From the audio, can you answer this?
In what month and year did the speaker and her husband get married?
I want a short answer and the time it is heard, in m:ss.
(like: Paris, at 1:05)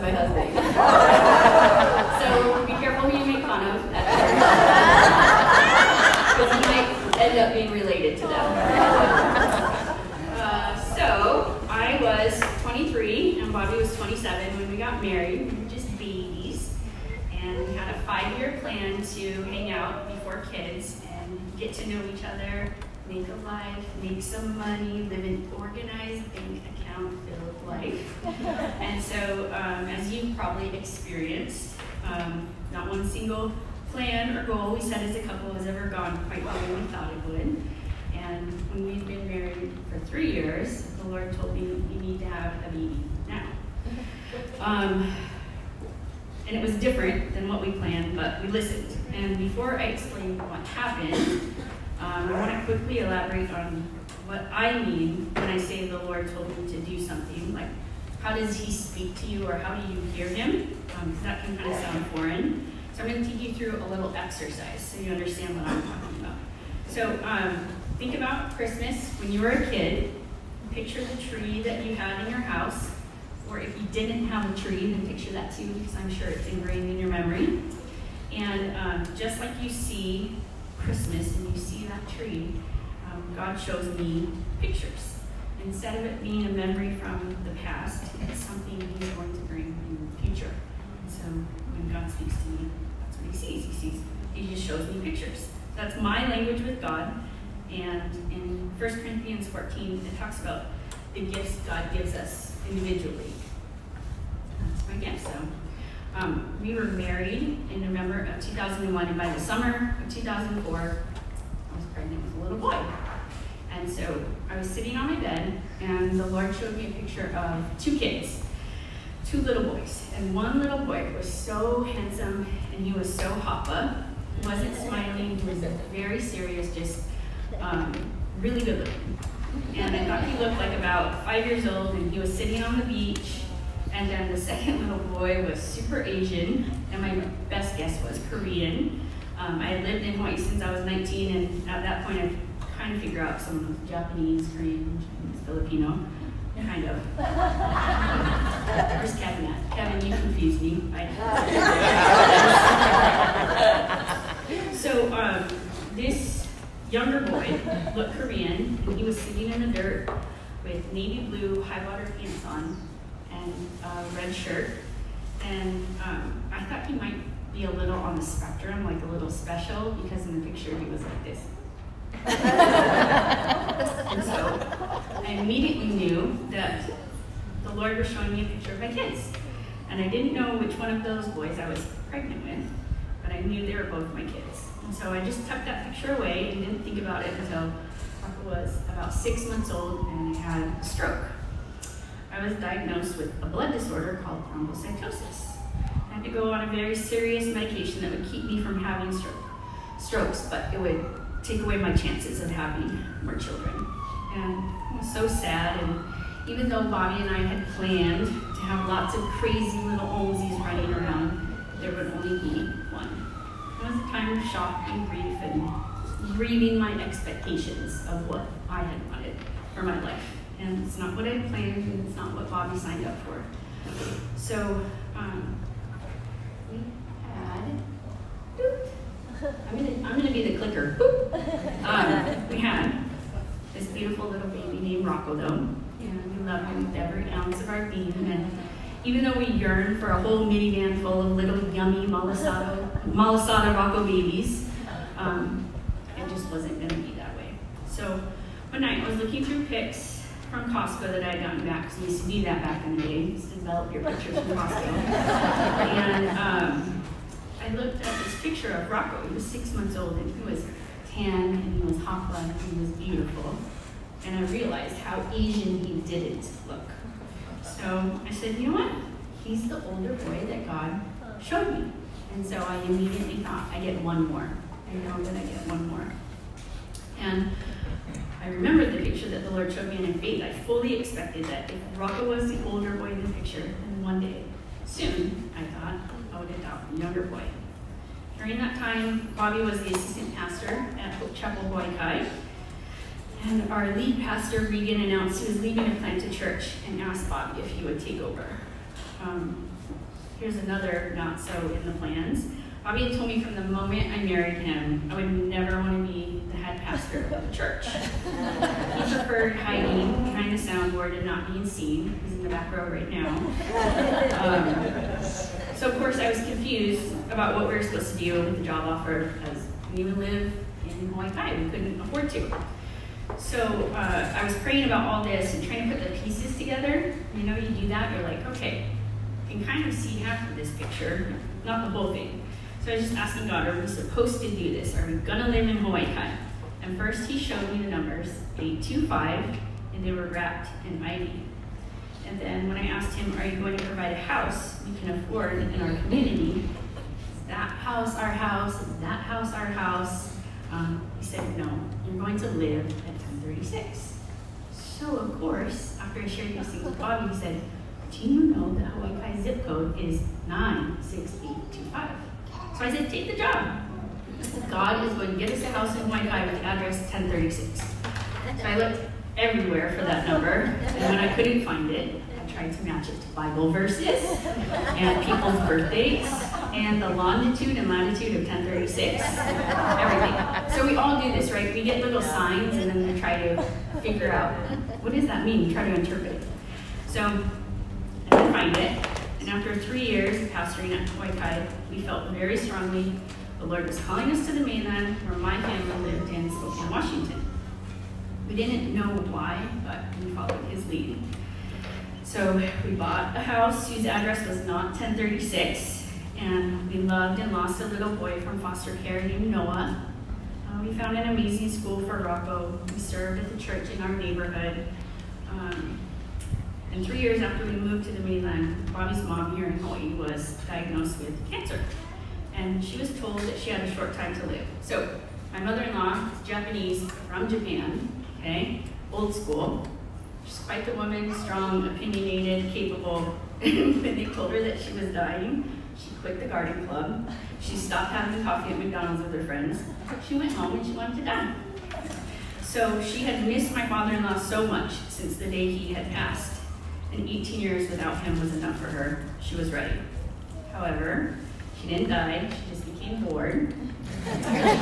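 November 2001, at 1:47.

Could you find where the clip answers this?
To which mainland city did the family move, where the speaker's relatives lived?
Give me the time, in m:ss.
6:36.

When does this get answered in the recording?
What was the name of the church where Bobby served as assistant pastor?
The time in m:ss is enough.
4:51.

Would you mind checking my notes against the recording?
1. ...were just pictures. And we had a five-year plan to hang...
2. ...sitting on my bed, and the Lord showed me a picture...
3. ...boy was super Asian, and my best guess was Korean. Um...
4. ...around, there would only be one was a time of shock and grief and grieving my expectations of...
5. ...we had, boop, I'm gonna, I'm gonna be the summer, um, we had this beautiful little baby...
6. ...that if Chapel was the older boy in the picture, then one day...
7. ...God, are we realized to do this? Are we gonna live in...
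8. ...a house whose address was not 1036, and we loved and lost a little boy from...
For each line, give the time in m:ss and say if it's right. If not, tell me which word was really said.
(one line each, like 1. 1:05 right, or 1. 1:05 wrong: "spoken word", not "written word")
1. 0:15 wrong: "babies", not "pictures"
2. 1:54 right
3. 2:15 right
4. 3:30 right
5. 3:46 wrong: "clicker", not "summer"
6. 4:41 wrong: "Rocco", not "Chapel"
7. 5:33 wrong: "supposed", not "realized"
8. 6:43 right.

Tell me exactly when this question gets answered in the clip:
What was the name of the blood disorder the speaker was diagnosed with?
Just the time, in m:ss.
3:14.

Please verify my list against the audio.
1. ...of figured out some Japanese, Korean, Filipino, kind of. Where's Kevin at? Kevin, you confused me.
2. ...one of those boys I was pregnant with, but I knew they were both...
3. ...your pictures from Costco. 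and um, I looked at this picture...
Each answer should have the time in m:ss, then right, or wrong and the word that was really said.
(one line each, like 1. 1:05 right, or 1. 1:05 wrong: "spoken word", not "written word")
1. 2:22 right
2. 3:00 right
3. 4:13 right.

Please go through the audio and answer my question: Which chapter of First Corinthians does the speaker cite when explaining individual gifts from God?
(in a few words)
14.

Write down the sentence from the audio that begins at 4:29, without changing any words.
He's the older boy that God showed me.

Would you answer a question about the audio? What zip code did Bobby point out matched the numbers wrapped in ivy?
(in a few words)
96825.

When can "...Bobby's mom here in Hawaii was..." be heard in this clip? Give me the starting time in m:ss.
6:58.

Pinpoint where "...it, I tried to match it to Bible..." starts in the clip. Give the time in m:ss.
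6:11.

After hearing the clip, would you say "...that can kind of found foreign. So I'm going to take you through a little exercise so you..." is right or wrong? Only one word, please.
wrong.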